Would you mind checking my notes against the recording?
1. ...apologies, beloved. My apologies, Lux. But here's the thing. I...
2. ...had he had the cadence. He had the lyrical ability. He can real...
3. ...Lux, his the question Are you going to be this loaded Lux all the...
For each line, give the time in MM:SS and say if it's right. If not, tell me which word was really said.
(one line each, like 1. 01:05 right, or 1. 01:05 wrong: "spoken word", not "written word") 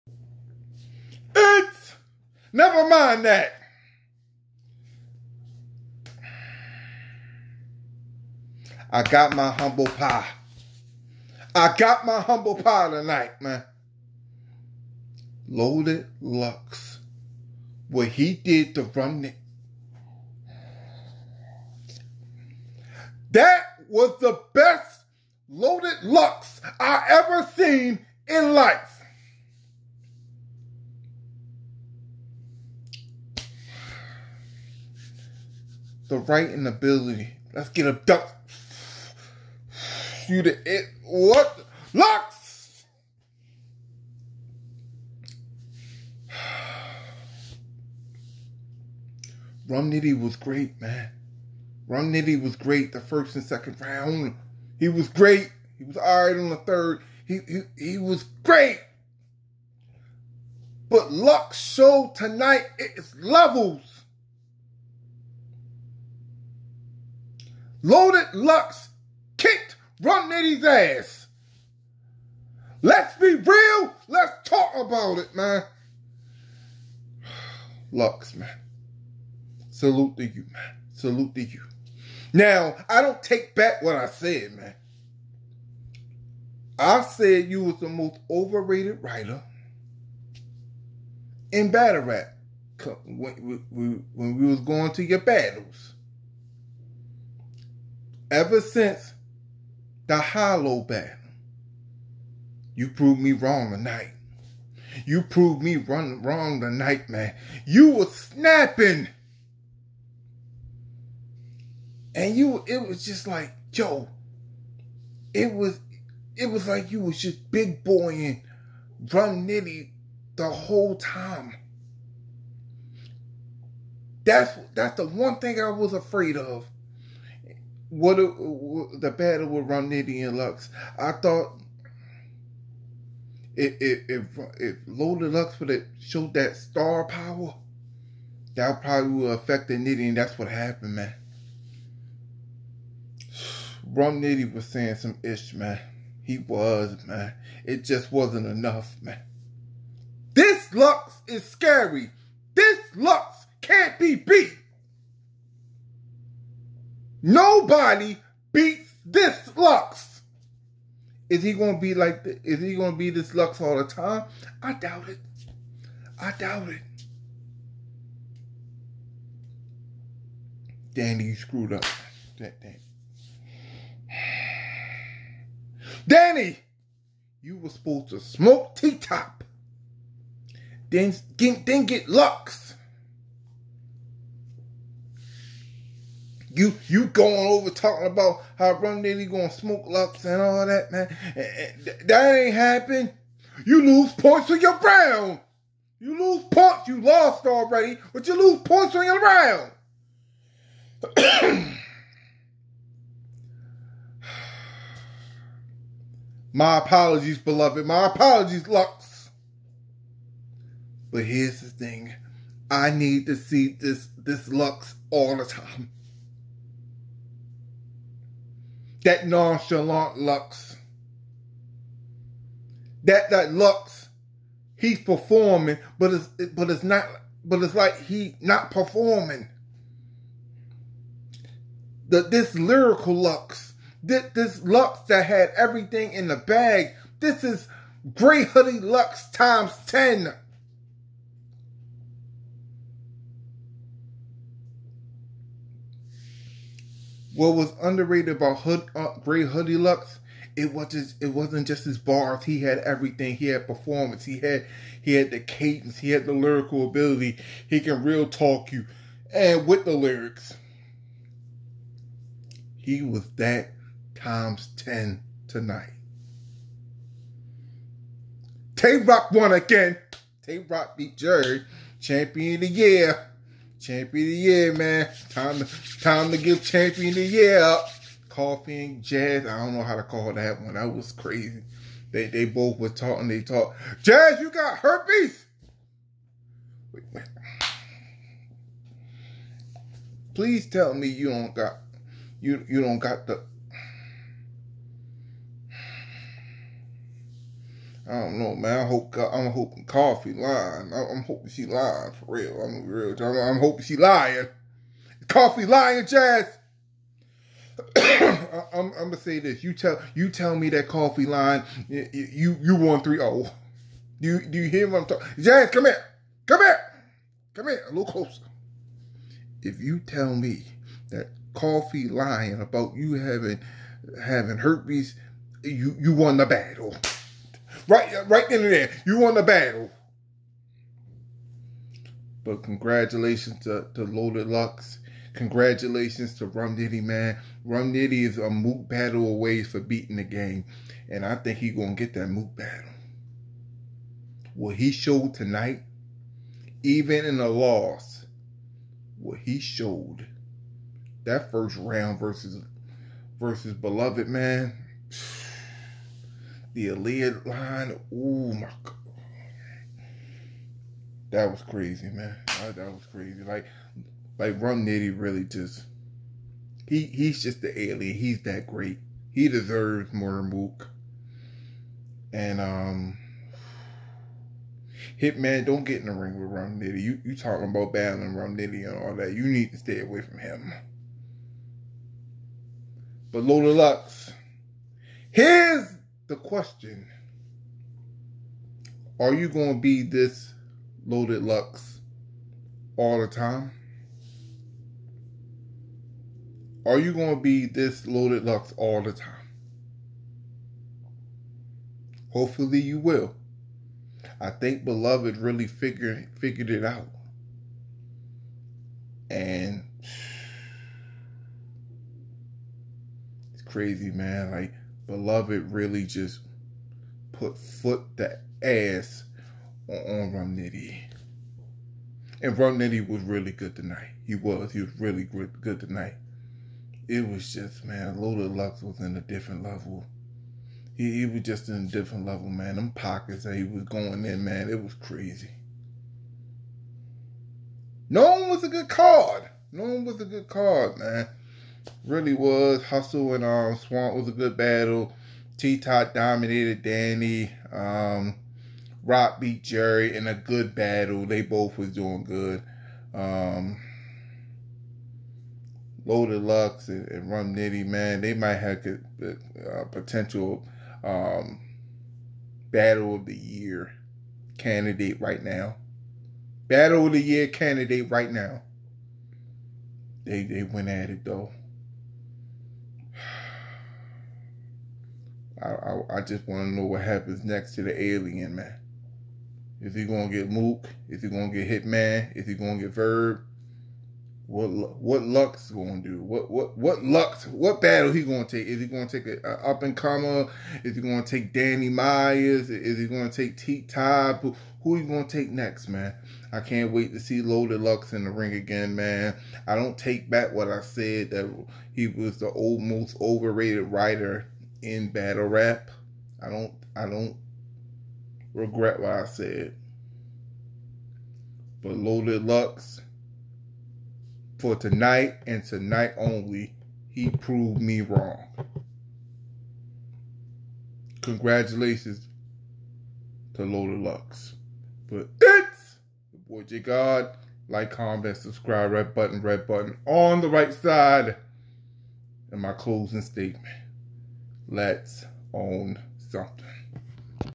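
1. 03:26 right
2. 04:14 right
3. 06:23 right.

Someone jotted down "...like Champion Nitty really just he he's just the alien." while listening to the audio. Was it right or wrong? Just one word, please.
wrong.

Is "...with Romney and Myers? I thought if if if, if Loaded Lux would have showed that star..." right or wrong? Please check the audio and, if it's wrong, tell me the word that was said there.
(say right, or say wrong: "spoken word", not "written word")
wrong: "Lux", not "Myers".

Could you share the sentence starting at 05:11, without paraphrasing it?
You you, you one three zero.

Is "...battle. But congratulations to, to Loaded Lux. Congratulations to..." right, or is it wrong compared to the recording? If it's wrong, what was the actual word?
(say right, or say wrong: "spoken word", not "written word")
right.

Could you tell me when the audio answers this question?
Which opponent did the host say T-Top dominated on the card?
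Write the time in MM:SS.
08:11.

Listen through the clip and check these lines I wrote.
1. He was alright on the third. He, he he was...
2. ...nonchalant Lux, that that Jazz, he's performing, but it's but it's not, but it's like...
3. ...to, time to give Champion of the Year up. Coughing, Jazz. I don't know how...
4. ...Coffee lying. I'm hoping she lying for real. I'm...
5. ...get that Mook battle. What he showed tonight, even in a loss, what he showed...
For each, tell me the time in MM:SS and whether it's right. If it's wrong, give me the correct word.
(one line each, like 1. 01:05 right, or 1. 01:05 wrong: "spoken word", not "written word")
1. 00:55 right
2. 03:39 wrong: "Lux", not "Jazz"
3. 04:35 right
4. 04:59 right
5. 05:42 right.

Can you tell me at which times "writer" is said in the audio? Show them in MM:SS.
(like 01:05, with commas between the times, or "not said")
01:29, 08:23.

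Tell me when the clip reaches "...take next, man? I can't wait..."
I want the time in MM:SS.
08:15.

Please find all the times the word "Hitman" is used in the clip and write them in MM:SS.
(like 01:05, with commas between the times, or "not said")
06:15, 08:01.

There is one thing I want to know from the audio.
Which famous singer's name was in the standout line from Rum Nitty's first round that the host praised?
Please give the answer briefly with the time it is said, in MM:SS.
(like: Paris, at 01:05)
Aaliyah, at 05:56.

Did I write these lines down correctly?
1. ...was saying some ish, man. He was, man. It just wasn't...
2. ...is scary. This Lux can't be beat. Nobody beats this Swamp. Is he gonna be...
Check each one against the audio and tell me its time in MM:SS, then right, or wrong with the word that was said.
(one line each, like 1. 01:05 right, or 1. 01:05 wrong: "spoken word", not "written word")
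1. 02:24 right
2. 02:31 wrong: "Lux", not "Swamp".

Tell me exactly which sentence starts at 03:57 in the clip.
This is Grey Hoodie Lux times ten.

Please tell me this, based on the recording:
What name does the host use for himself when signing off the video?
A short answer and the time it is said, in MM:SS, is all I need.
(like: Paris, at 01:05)
J Gard, at 08:46.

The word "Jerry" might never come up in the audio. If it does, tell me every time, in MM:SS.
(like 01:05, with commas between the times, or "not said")
04:31, 07:29.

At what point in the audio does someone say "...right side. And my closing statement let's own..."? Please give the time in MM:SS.
08:50.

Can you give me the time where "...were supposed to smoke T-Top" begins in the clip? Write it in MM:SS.
02:57.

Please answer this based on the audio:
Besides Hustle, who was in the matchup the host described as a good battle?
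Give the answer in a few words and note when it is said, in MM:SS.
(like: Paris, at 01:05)
Swamp, at 07:23.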